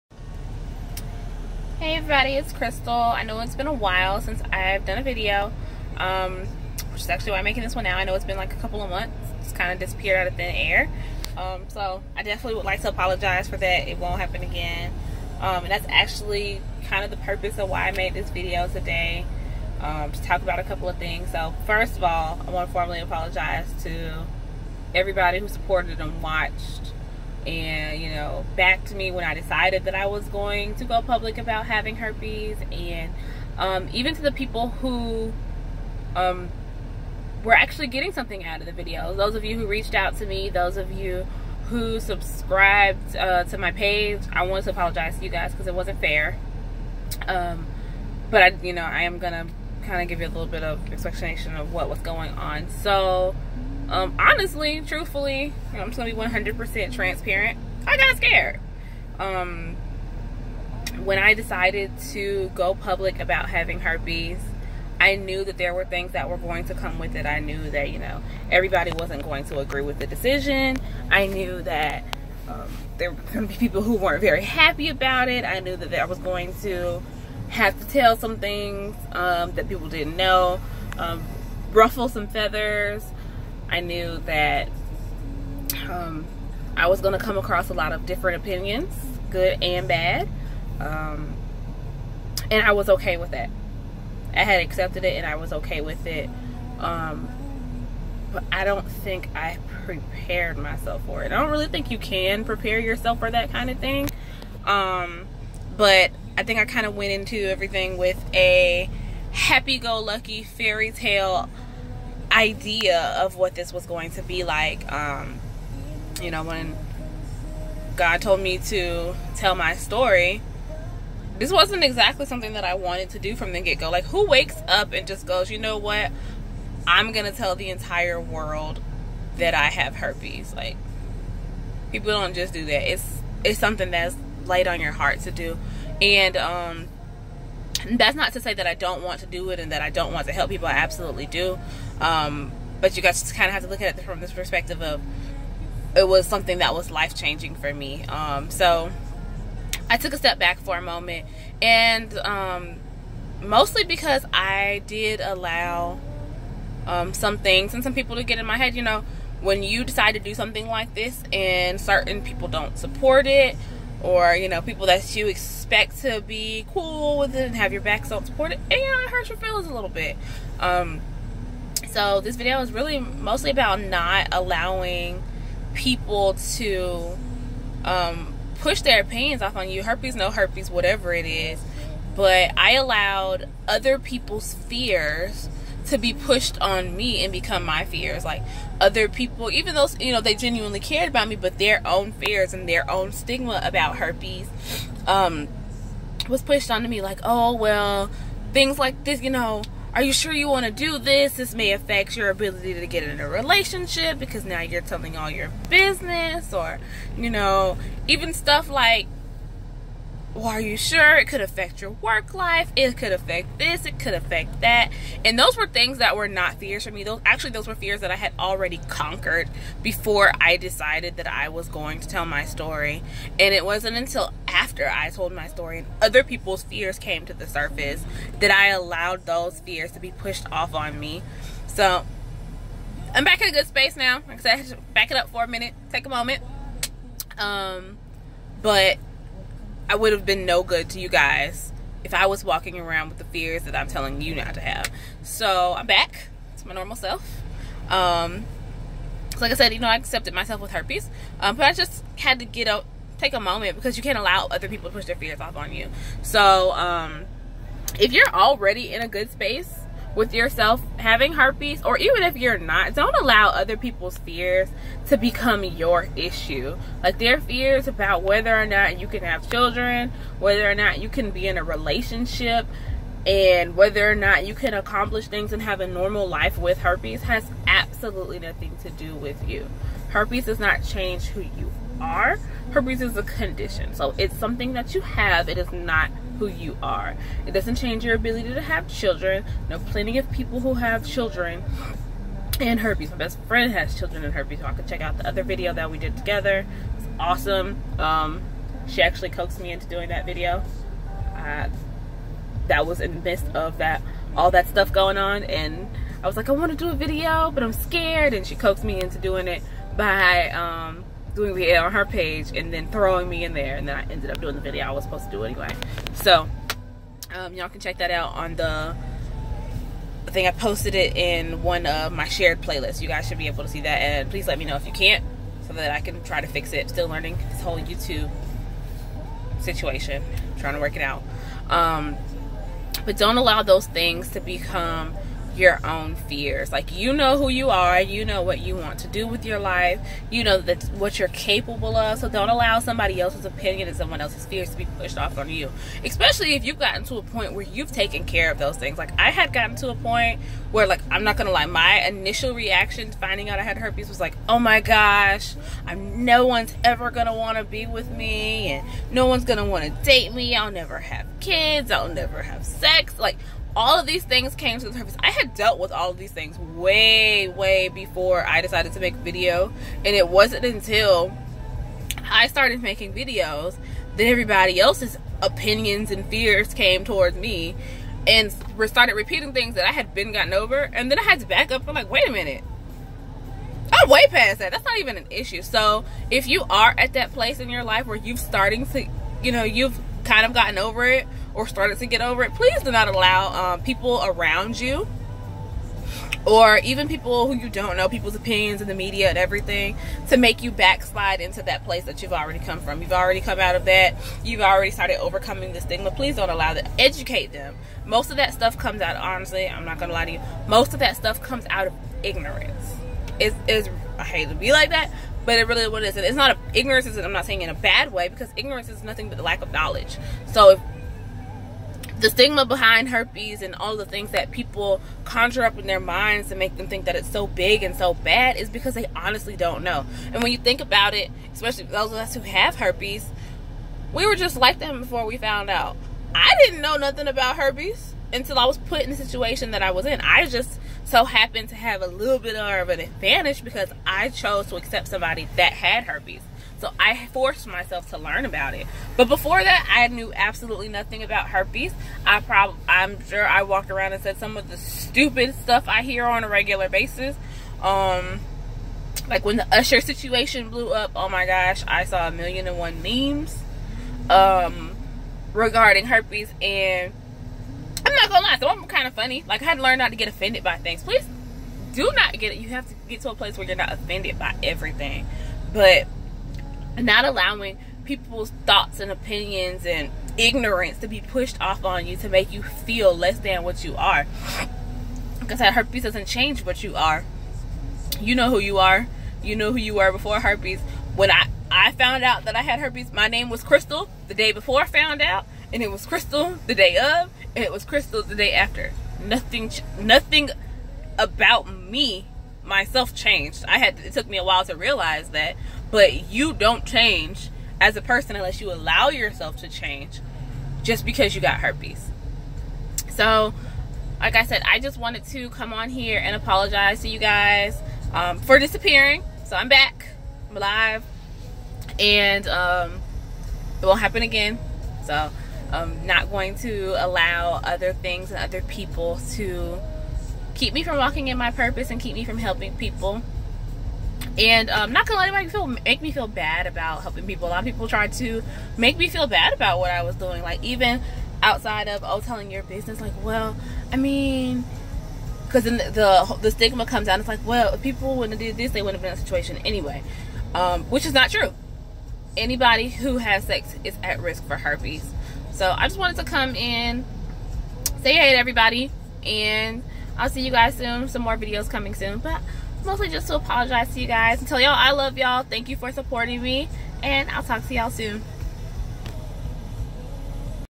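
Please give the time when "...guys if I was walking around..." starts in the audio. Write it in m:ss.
4:01.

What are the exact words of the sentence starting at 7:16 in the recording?
I didn't know nothing about herpes until I was put in the situation that I was in.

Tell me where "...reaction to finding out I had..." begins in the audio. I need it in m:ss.
5:52.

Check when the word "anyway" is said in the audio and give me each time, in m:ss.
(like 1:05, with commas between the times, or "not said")
5:15, 9:09.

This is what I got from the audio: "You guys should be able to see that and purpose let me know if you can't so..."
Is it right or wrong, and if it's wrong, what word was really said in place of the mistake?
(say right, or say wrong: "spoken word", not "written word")
wrong: "please", not "purpose".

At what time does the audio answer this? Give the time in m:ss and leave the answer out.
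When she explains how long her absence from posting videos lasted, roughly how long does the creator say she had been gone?
0:08.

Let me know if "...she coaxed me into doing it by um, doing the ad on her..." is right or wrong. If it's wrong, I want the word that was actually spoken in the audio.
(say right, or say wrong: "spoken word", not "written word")
right.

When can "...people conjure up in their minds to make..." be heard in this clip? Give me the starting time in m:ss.
7:04.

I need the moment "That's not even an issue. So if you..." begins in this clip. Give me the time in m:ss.
6:24.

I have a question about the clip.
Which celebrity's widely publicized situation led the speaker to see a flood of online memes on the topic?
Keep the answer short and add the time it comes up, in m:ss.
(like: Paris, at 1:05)
Usher, at 7:39.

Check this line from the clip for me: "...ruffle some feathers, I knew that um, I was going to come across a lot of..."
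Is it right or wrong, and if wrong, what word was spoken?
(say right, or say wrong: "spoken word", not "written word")
right.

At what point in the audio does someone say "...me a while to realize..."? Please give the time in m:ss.
8:24.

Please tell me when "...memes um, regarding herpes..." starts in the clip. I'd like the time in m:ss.
7:43.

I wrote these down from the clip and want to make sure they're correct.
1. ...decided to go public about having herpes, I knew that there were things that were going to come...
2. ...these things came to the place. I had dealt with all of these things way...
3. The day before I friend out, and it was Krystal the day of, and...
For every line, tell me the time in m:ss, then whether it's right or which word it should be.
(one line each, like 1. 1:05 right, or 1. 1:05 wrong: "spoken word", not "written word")
1. 1:01 right
2. 6:04 wrong: "surface", not "place"
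3. 8:14 wrong: "found", not "friend".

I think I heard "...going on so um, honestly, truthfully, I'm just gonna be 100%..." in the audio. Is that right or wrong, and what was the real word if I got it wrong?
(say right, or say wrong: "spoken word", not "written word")
right.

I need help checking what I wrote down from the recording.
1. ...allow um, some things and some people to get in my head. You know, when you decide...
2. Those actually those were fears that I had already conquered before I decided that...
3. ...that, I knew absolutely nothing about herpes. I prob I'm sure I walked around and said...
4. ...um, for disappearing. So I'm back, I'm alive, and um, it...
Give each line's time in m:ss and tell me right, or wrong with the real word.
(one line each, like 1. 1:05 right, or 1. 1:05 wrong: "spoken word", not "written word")
1. 2:35 right
2. 3:37 right
3. 7:29 right
4. 8:38 right.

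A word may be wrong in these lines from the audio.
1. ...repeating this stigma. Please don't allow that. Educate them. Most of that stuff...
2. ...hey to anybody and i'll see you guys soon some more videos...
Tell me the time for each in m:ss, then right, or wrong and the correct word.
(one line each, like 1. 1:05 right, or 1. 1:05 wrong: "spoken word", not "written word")
1. 6:45 wrong: "overcoming", not "repeating"
2. 9:18 wrong: "everybody", not "anybody".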